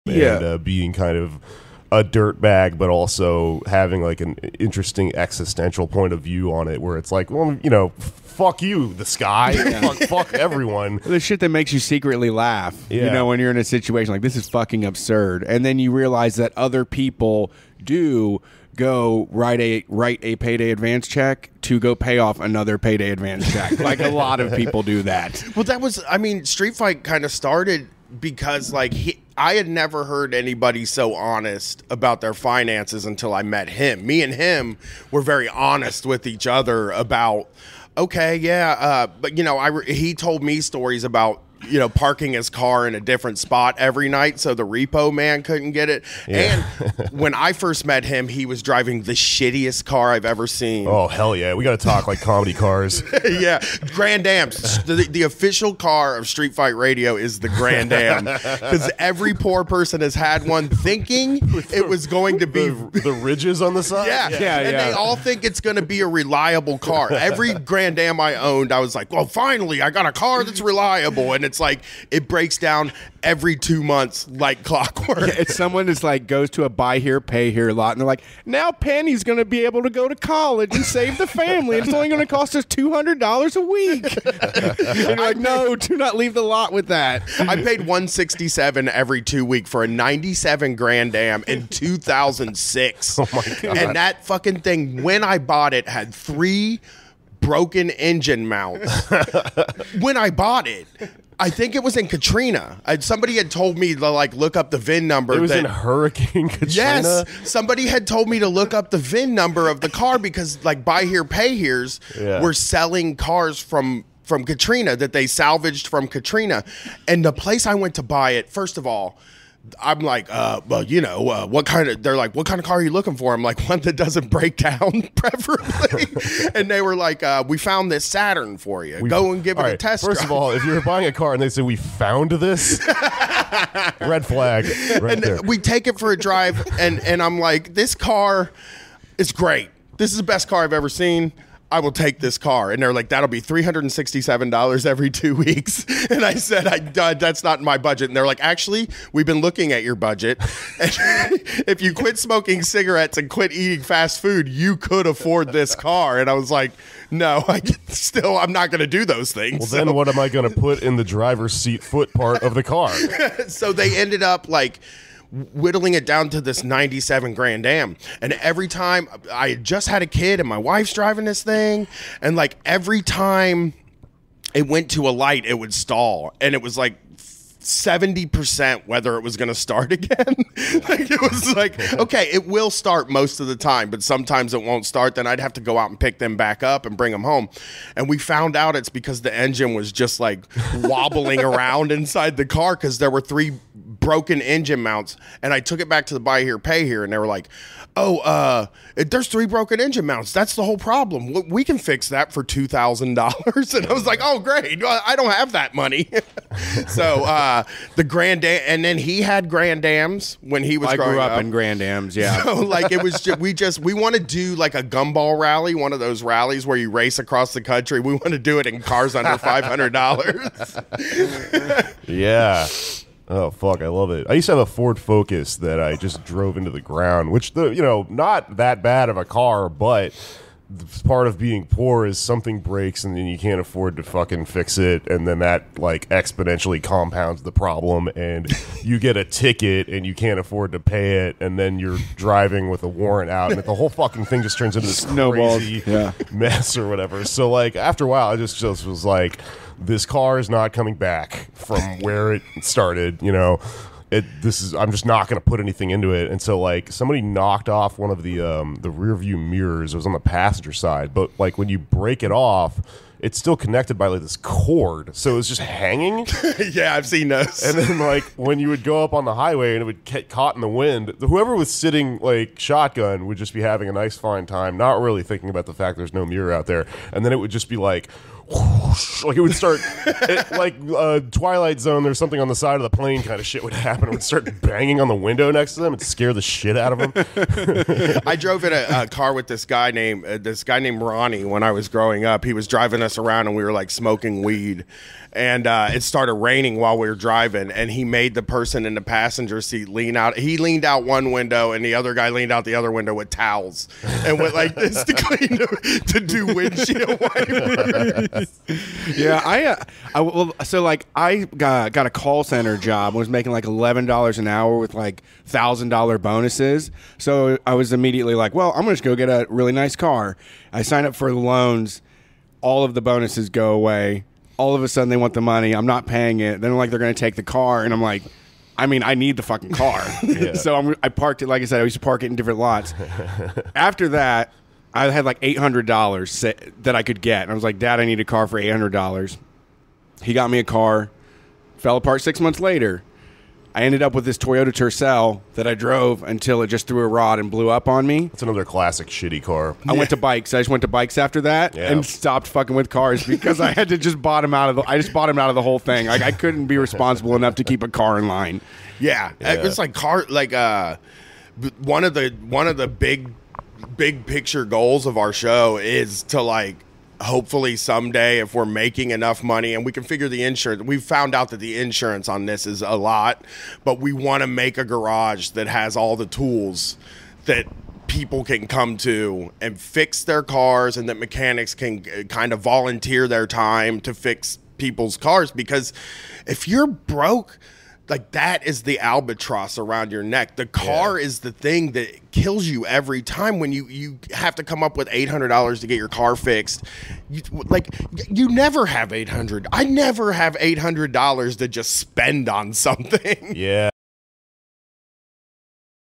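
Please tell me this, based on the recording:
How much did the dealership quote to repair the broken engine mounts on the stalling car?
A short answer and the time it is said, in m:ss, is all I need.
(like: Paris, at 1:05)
$2,000, at 3:22.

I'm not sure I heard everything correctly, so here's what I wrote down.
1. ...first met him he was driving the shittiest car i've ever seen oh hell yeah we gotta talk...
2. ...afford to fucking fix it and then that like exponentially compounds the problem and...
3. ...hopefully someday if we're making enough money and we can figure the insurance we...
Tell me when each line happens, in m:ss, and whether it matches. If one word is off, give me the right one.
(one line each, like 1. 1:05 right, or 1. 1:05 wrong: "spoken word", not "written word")
1. 0:47 right
2. 3:53 right
3. 6:07 right.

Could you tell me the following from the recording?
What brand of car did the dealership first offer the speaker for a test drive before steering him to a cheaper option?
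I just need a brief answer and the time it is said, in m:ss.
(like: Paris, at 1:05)
Saturn, at 2:08.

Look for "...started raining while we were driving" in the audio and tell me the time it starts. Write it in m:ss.
4:56.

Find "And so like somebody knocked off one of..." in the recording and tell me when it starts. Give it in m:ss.
4:16.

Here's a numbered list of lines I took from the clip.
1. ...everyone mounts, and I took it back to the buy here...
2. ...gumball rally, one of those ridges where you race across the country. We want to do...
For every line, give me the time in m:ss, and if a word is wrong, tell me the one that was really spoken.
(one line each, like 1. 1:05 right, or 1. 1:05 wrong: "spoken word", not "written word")
1. 3:14 wrong: "engine", not "everyone"
2. 3:34 wrong: "rallies", not "ridges".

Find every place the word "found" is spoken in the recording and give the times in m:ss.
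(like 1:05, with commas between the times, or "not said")
2:07, 2:11, 3:08, 6:10.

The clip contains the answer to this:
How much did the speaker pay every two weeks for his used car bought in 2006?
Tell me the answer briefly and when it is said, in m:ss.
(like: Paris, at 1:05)
$167, at 1:27.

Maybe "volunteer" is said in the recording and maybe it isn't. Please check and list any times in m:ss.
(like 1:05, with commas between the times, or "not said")
6:22.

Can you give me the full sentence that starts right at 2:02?
They're like, what kind of car are you looking for?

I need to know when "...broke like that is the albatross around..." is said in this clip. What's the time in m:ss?
6:26.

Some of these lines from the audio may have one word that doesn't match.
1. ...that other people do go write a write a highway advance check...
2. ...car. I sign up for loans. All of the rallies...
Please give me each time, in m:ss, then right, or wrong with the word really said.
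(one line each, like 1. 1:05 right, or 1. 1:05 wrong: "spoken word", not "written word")
1. 0:16 wrong: "payday", not "highway"
2. 5:19 wrong: "bonuses", not "rallies".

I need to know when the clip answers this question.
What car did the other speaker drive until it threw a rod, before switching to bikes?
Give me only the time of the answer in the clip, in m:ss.
5:44.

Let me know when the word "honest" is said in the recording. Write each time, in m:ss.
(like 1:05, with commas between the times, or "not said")
0:31, 0:35.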